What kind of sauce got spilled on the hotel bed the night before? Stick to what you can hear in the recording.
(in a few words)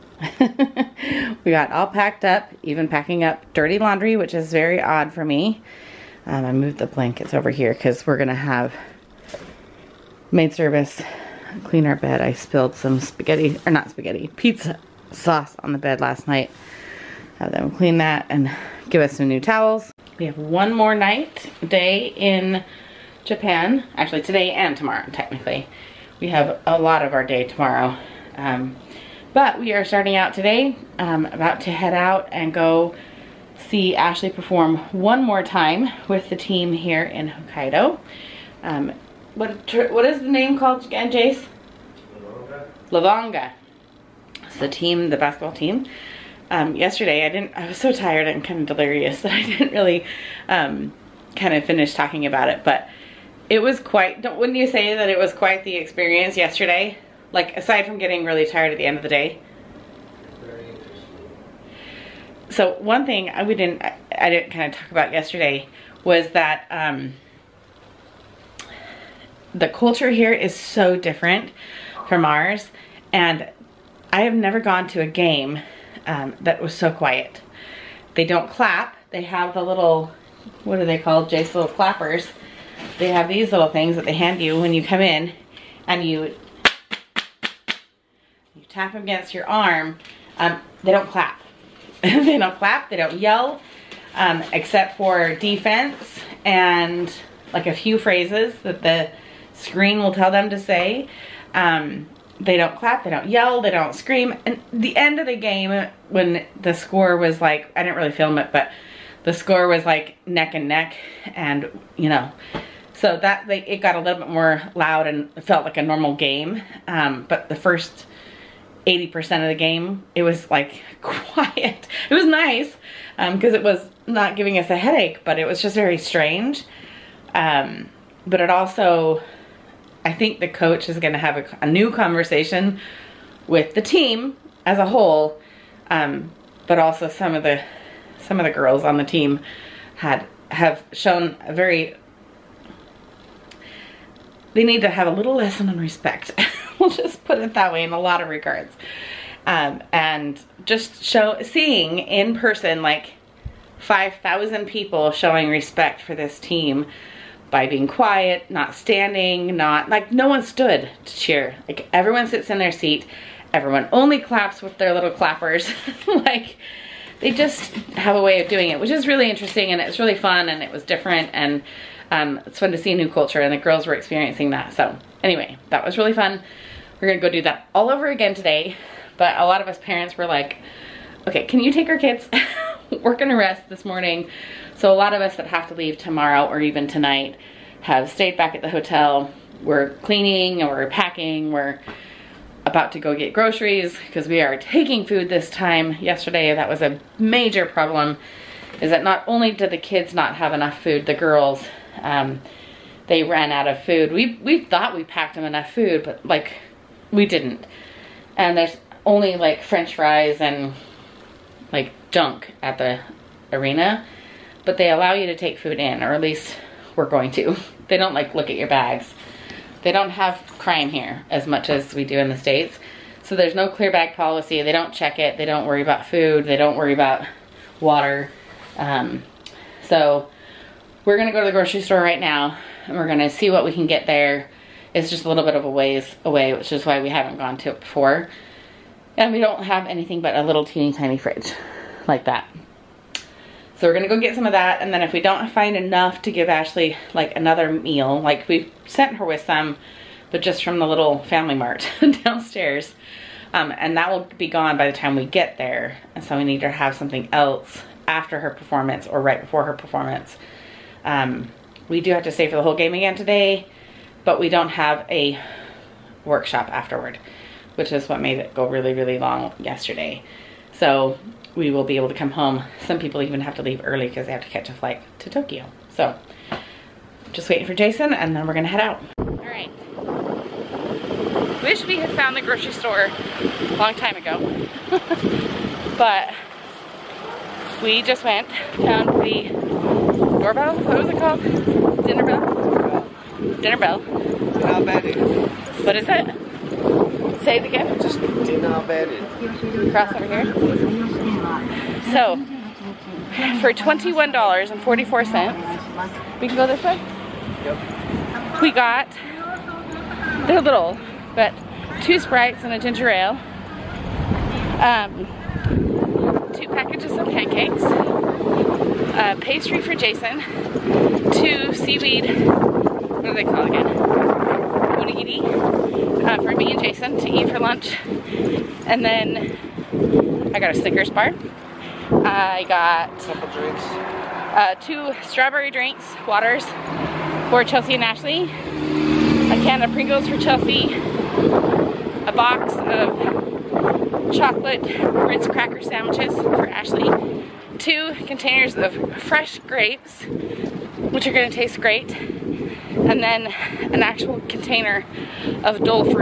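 Pizza sauce.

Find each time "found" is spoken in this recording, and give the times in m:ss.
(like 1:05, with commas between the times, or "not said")
4:42, 4:48.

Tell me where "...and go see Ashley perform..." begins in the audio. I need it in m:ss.
0:32.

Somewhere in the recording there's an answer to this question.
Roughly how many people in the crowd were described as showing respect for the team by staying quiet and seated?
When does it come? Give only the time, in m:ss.
2:33.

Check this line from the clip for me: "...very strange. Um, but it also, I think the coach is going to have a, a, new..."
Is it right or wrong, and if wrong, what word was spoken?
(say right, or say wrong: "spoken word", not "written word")
right.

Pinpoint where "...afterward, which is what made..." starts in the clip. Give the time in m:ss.
4:26.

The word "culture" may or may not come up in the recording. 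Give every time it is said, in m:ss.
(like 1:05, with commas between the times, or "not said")
1:09, 2:53.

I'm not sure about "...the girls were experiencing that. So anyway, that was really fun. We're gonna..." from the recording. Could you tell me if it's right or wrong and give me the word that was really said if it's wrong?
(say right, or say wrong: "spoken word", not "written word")
right.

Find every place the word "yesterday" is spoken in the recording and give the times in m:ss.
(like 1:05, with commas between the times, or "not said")
0:46, 0:56, 1:05, 3:16, 4:29.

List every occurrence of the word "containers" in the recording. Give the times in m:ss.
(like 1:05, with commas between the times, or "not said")
5:48, 5:54.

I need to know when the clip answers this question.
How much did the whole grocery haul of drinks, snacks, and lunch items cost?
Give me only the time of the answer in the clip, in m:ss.
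5:03.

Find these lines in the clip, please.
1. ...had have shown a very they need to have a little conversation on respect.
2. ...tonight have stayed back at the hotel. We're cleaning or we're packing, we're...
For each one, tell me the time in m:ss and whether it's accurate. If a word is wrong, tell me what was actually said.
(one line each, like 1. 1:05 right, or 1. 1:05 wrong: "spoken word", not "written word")
1. 2:19 wrong: "lesson", not "conversation"
2. 3:06 right.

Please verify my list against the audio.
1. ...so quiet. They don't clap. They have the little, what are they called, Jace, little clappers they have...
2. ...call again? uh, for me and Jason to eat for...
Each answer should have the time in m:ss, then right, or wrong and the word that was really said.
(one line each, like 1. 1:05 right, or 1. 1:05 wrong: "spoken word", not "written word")
1. 1:16 right
2. 5:23 right.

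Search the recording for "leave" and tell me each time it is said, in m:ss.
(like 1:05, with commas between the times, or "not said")
3:05, 4:33.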